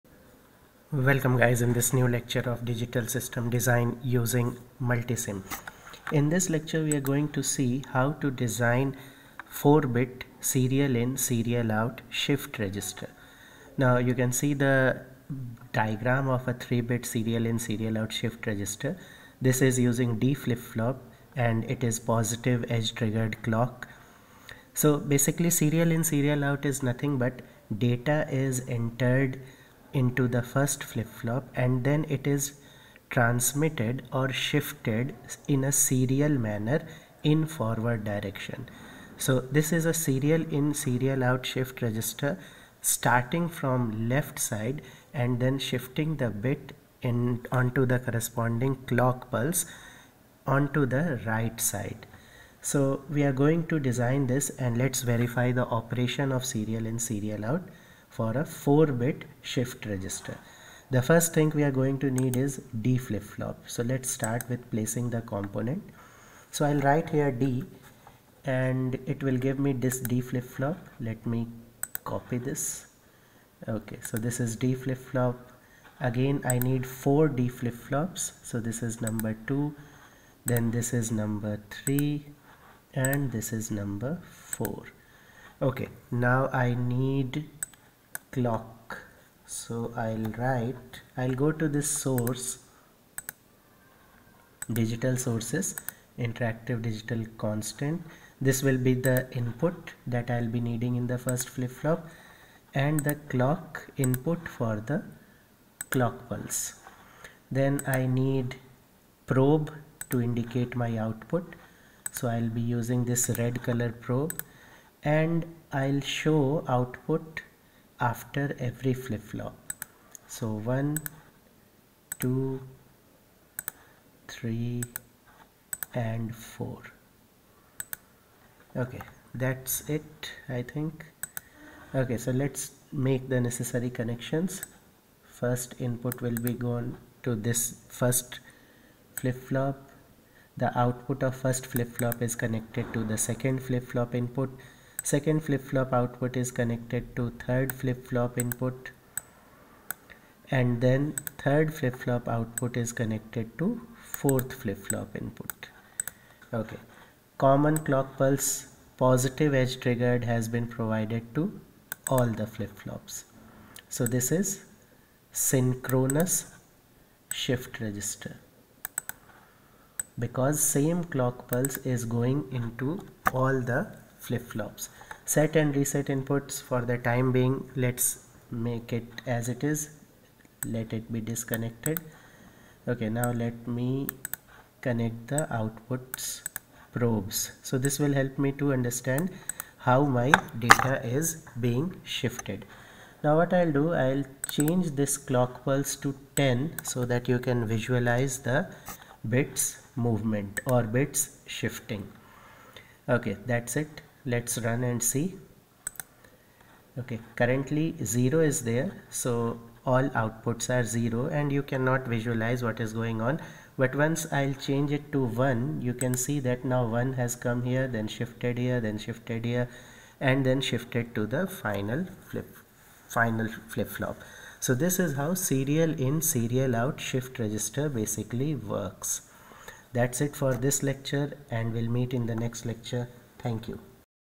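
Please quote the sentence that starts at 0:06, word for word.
In this lecture we are going to see how to design 4-bit serial in serial out shift register.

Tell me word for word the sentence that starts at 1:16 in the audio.
Again, I need four D flip-flops.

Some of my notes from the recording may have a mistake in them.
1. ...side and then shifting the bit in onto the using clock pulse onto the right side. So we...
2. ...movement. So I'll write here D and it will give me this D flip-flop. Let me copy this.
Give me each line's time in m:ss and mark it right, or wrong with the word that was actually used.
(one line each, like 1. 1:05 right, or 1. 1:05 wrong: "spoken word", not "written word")
1. 0:44 wrong: "corresponding", not "using"
2. 1:05 wrong: "component", not "movement".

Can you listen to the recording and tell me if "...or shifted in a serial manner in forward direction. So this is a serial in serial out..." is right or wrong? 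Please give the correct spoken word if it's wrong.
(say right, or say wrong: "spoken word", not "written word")
right.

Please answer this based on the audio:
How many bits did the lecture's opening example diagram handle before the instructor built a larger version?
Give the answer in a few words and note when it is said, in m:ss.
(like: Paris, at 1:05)
3, at 0:16.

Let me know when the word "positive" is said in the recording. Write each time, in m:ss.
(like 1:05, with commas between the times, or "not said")
0:22, 2:38.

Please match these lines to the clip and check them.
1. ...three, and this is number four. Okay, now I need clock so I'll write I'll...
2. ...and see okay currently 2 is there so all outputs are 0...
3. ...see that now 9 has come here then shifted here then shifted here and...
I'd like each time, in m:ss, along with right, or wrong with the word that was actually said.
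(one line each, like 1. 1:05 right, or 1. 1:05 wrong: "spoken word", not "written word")
1. 1:21 right
2. 3:24 wrong: "0", not "2"
3. 3:36 wrong: "1", not "9".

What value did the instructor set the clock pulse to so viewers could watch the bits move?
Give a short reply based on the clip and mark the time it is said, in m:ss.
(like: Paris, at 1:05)
10, at 3:16.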